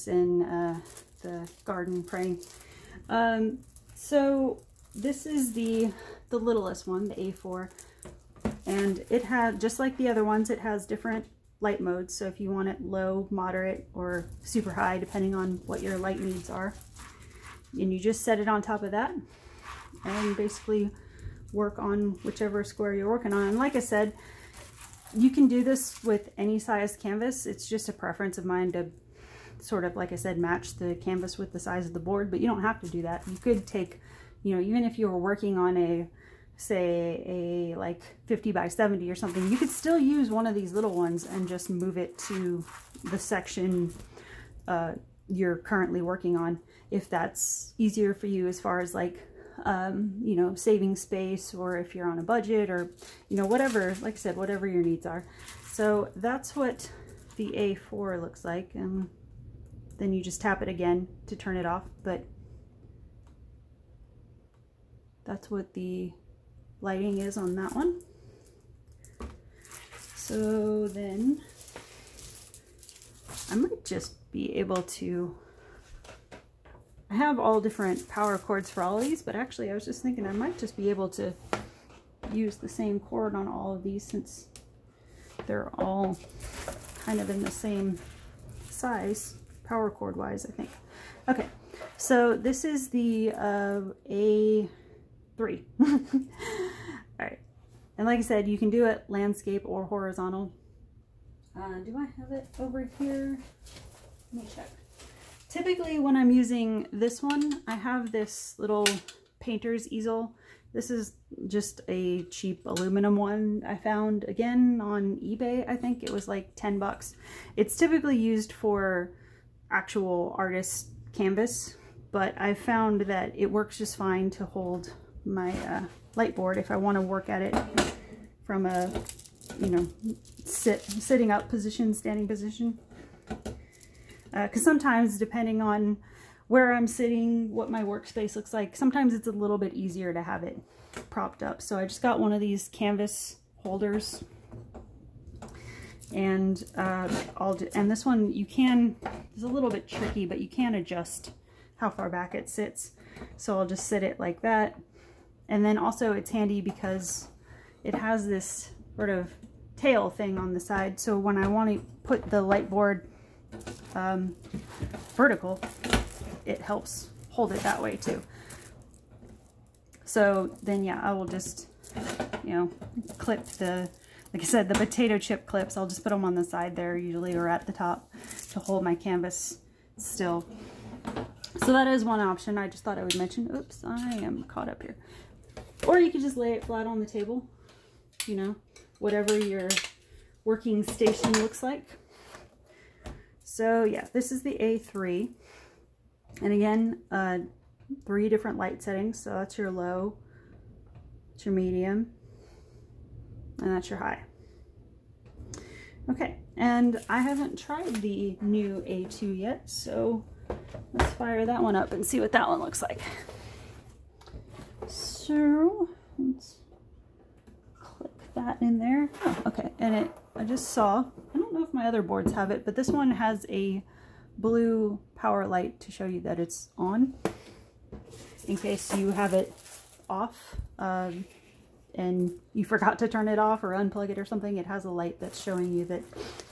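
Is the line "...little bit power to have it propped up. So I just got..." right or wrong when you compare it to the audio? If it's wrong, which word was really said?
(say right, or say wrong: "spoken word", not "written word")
wrong: "easier", not "power".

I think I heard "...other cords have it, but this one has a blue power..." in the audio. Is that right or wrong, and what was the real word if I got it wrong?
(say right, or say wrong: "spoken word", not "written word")
wrong: "boards", not "cords".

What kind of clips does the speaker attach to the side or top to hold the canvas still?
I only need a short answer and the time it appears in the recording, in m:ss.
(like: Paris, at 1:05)
Potato chip clips, at 2:54.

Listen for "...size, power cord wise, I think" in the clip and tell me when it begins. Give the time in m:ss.
1:28.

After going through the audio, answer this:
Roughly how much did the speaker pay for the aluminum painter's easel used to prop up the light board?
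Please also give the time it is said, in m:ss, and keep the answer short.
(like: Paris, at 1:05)
$10, at 1:56.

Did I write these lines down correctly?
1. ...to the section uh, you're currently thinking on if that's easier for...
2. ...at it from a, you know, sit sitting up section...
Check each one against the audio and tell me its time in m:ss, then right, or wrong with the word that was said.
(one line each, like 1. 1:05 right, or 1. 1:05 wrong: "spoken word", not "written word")
1. 0:42 wrong: "working", not "thinking"
2. 2:07 wrong: "position", not "section".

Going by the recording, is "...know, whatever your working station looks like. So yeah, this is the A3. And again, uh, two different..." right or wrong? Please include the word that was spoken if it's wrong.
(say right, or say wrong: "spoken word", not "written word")
wrong: "three", not "two".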